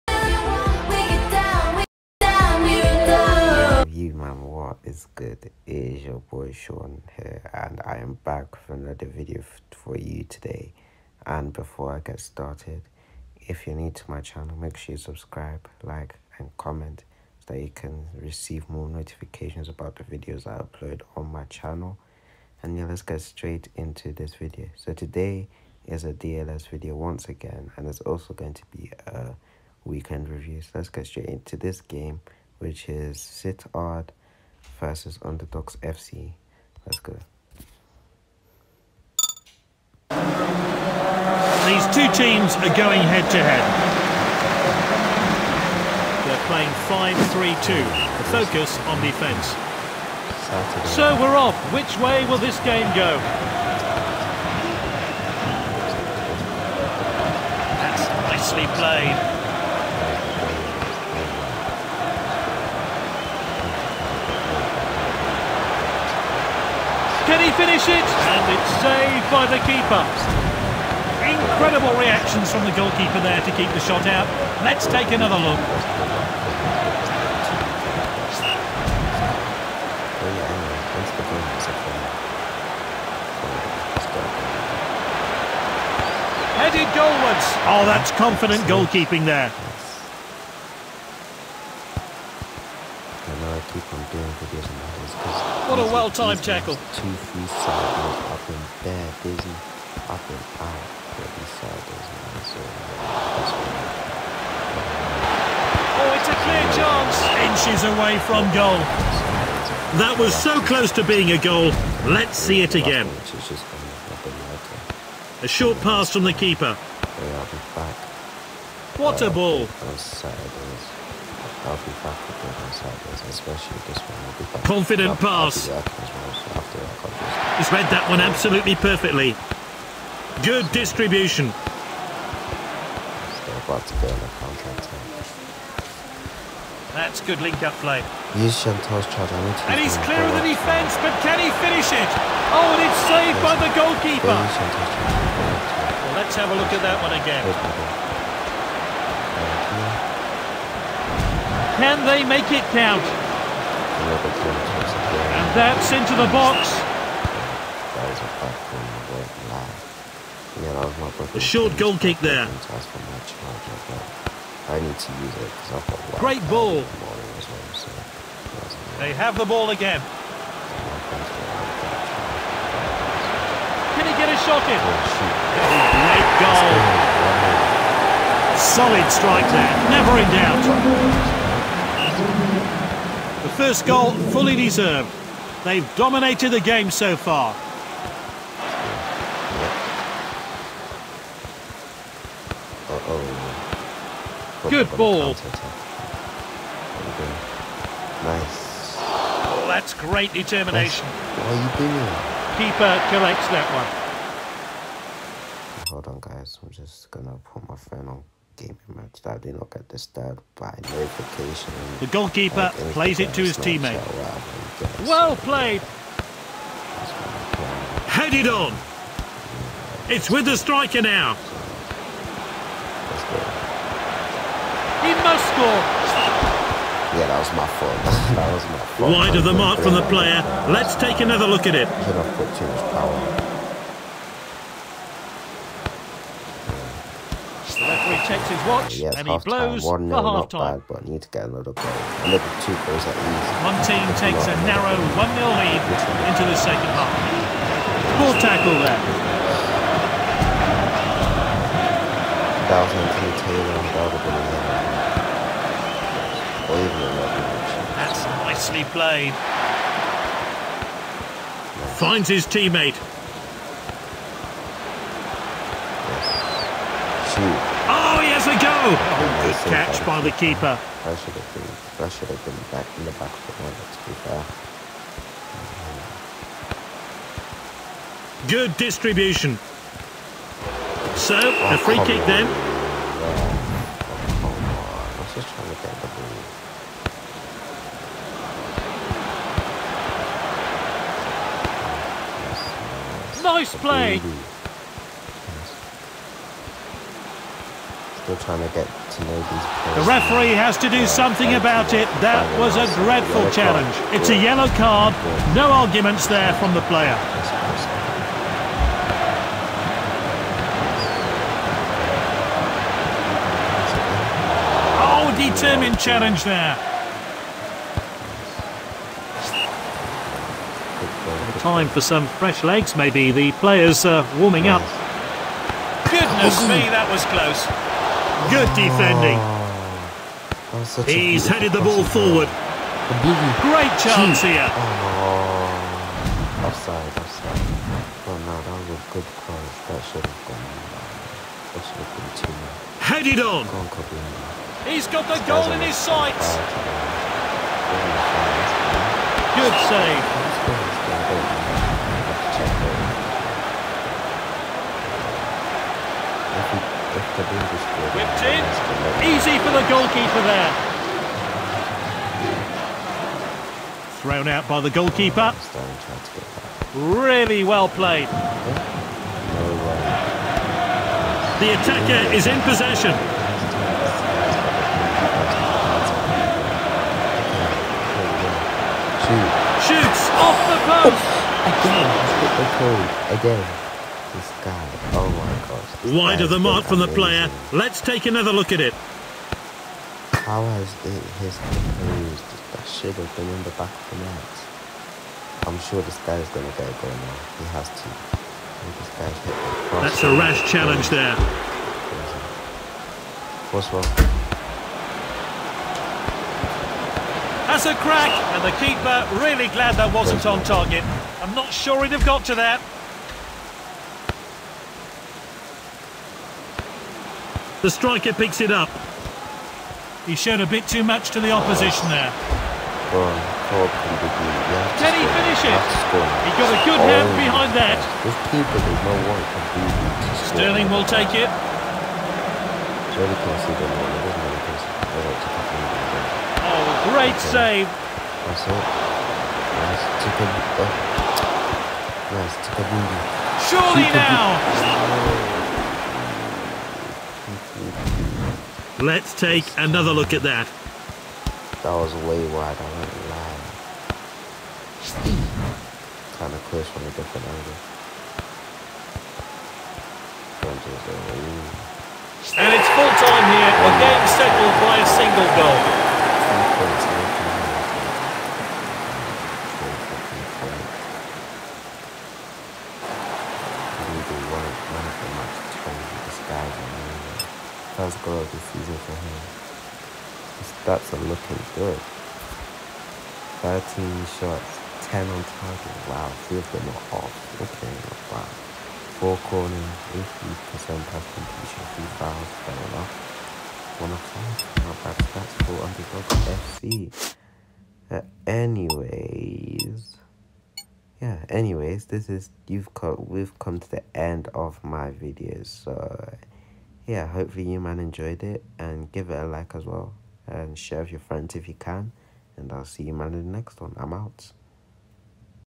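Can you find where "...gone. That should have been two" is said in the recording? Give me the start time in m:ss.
5:40.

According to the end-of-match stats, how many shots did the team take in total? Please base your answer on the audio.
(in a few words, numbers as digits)
13.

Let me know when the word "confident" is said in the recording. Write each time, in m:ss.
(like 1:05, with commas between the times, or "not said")
1:28, 2:04.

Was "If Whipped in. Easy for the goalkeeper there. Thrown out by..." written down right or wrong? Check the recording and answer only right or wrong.
right.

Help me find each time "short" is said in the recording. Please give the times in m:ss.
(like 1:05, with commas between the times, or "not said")
1:55, 2:41.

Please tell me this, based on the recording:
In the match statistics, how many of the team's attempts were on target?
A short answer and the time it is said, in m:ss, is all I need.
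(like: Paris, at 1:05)
10, at 8:05.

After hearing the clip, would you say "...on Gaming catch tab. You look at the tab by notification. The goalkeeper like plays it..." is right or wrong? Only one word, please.
wrong.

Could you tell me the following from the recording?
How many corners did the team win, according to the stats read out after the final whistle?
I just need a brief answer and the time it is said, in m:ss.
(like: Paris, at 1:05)
4, at 8:09.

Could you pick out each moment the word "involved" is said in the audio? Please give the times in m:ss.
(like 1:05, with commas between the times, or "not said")
not said.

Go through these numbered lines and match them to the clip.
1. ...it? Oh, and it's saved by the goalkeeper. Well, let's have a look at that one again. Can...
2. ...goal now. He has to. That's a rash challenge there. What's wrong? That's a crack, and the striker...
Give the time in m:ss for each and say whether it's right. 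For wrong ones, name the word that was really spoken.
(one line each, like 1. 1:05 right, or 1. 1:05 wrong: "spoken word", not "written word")
1. 2:21 right
2. 6:37 wrong: "keeper", not "striker".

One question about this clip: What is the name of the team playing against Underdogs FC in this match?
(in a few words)
Sittard.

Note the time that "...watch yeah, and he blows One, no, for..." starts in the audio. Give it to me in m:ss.
3:58.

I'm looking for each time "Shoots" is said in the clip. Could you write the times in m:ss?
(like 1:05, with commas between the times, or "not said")
6:19.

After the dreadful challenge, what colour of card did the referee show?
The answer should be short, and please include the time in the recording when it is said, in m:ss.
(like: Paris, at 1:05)
Yellow, at 5:04.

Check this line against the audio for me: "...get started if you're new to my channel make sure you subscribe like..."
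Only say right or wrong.
right.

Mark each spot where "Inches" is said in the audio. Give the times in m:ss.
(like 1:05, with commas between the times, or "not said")
1:47.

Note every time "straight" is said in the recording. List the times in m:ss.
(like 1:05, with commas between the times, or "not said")
0:23, 0:31.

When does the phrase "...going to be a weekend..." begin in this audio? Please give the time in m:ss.
0:28.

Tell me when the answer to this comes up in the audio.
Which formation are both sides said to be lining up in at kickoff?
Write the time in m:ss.
0:46.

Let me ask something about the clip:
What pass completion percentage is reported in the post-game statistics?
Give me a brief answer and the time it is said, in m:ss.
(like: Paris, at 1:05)
80%, at 8:10.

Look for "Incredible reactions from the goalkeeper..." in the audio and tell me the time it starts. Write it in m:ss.
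1:11.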